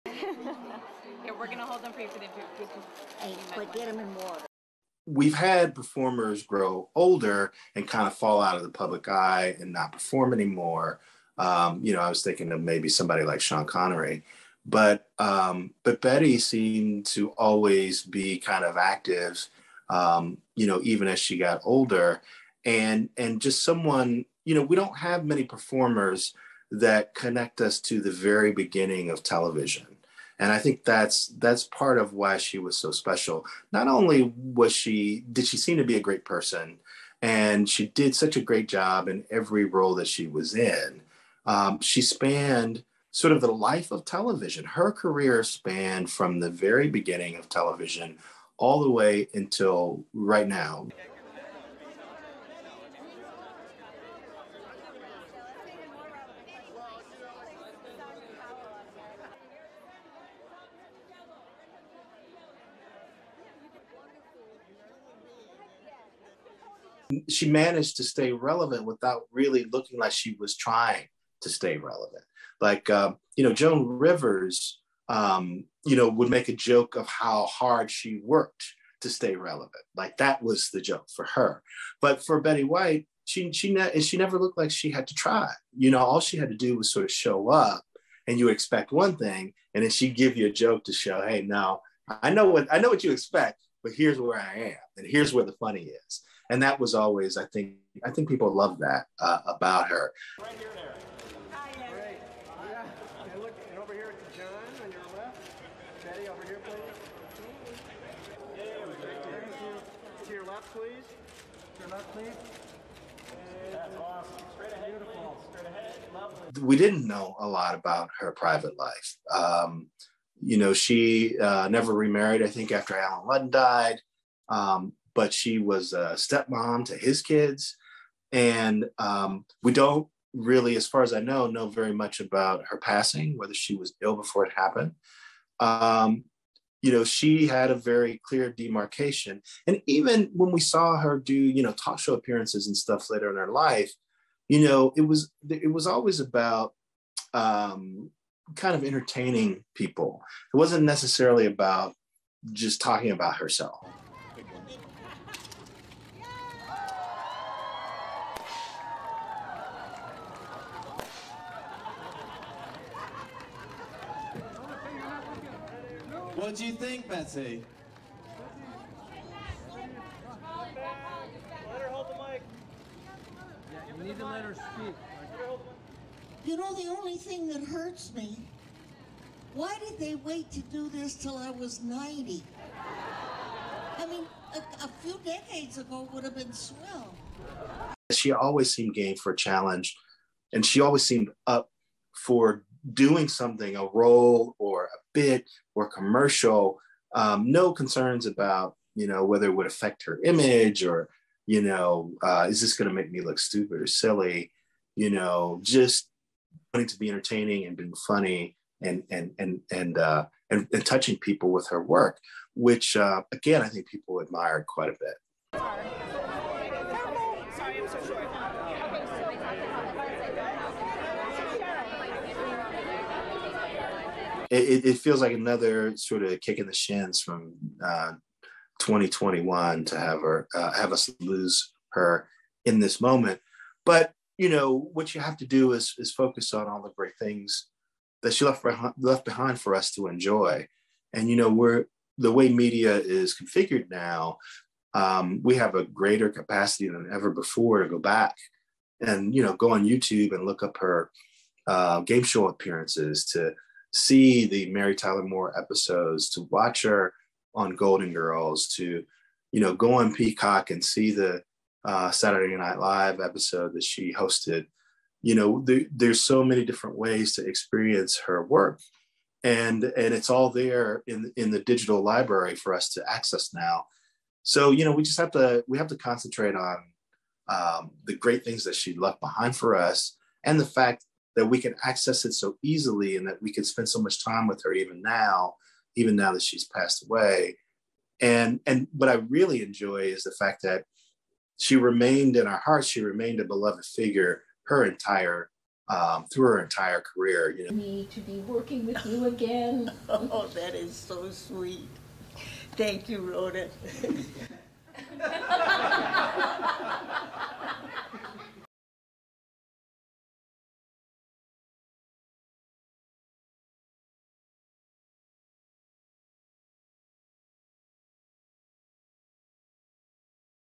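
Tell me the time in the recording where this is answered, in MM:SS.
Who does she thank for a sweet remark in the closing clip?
05:03.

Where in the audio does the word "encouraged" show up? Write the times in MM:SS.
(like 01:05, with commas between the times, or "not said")
not said.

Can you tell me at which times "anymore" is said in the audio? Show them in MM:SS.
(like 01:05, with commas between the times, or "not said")
00:10.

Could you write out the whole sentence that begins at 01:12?
Like, uh, you know, Joan Rivers, um, you know, would make a joke of how hard she worked to stay relevant.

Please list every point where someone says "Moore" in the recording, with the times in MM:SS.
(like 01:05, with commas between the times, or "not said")
04:15.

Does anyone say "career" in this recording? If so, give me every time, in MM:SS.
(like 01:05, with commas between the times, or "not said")
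00:44, 04:57.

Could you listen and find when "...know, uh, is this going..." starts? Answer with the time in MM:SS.
03:21.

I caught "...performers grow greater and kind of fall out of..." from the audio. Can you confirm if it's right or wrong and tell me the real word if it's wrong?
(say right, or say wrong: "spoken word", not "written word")
wrong: "older", not "greater".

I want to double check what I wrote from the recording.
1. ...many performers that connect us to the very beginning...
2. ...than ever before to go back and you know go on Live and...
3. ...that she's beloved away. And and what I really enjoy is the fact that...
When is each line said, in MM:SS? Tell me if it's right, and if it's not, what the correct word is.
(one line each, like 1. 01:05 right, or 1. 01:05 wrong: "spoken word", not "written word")
1. 00:25 right
2. 04:06 wrong: "YouTube", not "Live"
3. 04:46 wrong: "passed", not "beloved".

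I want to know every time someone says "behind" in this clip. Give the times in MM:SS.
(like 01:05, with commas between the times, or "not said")
03:59, 04:39.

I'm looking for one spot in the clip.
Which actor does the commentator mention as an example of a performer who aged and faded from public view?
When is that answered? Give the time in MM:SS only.
00:13.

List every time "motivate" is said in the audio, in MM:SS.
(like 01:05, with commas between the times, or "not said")
not said.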